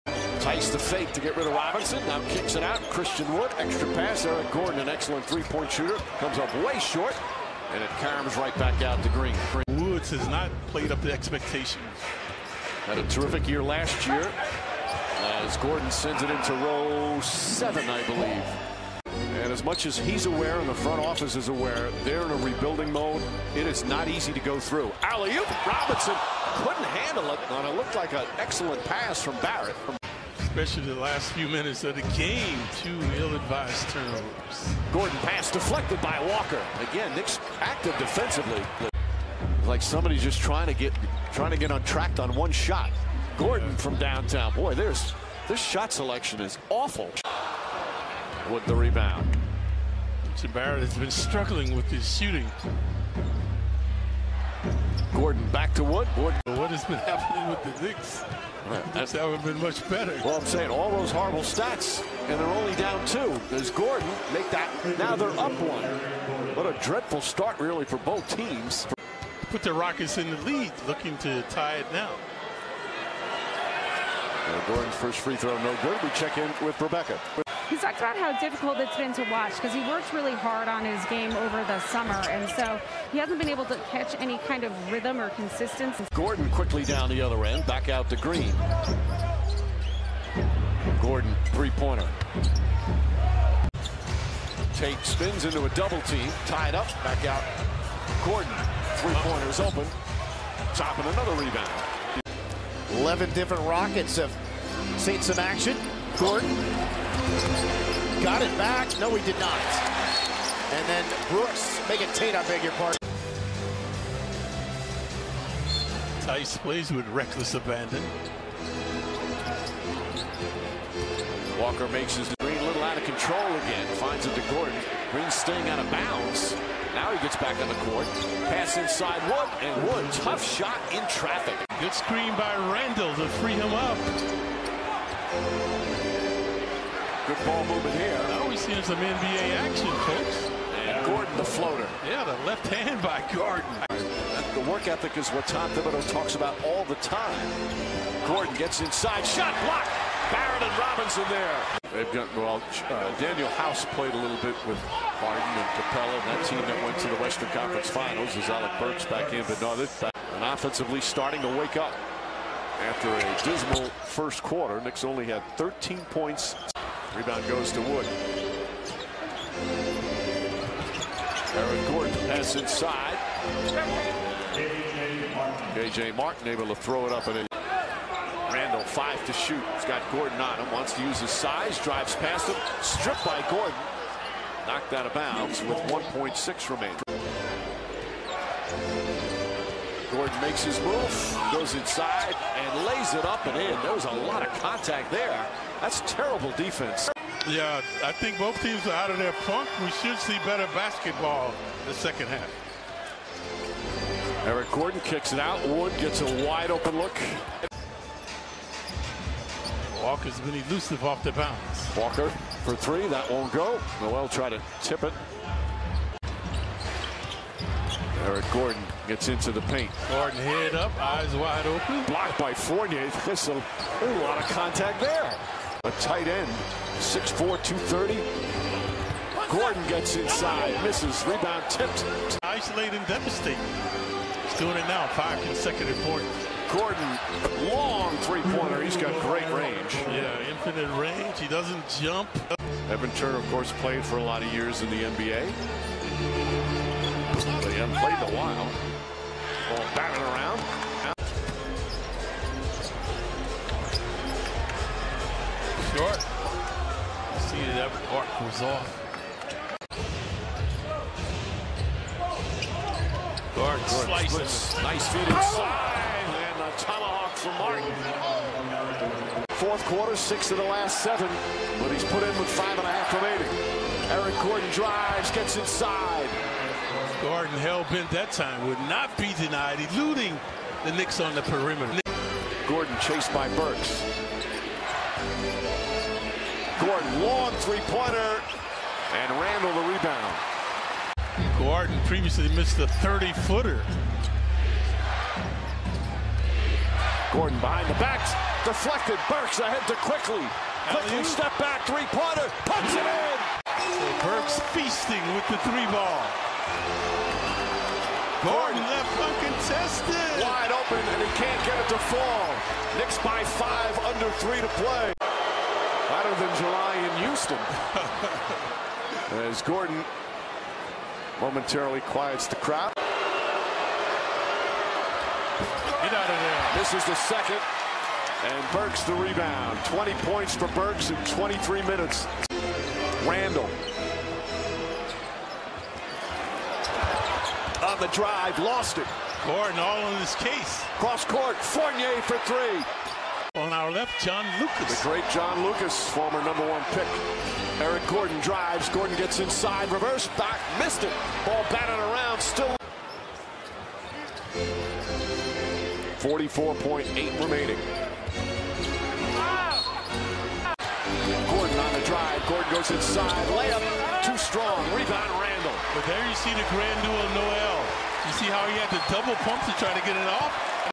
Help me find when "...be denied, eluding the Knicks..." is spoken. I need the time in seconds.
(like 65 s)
279 s.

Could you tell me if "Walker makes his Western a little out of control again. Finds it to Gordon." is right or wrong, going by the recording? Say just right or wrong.
wrong.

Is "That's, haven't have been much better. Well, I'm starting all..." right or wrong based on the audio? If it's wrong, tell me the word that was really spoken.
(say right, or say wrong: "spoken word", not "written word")
wrong: "saying", not "starting".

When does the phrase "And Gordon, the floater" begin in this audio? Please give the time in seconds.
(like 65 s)
140 s.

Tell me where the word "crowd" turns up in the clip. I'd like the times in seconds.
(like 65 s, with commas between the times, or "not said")
322 s.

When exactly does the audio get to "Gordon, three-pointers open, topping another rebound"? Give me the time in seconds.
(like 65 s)
98 s.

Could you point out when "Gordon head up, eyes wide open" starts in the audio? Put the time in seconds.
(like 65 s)
220 s.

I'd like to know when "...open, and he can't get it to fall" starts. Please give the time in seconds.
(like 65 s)
310 s.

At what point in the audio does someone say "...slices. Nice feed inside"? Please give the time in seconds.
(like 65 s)
263 s.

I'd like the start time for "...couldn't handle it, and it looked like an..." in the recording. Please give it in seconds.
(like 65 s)
26 s.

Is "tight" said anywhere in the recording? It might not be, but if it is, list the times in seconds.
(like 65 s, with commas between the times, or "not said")
225 s.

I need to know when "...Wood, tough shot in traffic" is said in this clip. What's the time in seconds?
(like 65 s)
129 s.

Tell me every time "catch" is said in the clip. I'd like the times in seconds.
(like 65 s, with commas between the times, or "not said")
83 s.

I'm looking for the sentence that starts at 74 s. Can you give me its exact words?
Gordon's first free throw no good.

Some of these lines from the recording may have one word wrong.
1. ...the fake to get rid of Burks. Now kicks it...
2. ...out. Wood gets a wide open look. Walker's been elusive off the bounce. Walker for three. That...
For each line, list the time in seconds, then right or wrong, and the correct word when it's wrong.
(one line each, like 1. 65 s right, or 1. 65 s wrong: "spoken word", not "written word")
1. 0 s wrong: "Robinson", not "Burks"
2. 205 s right.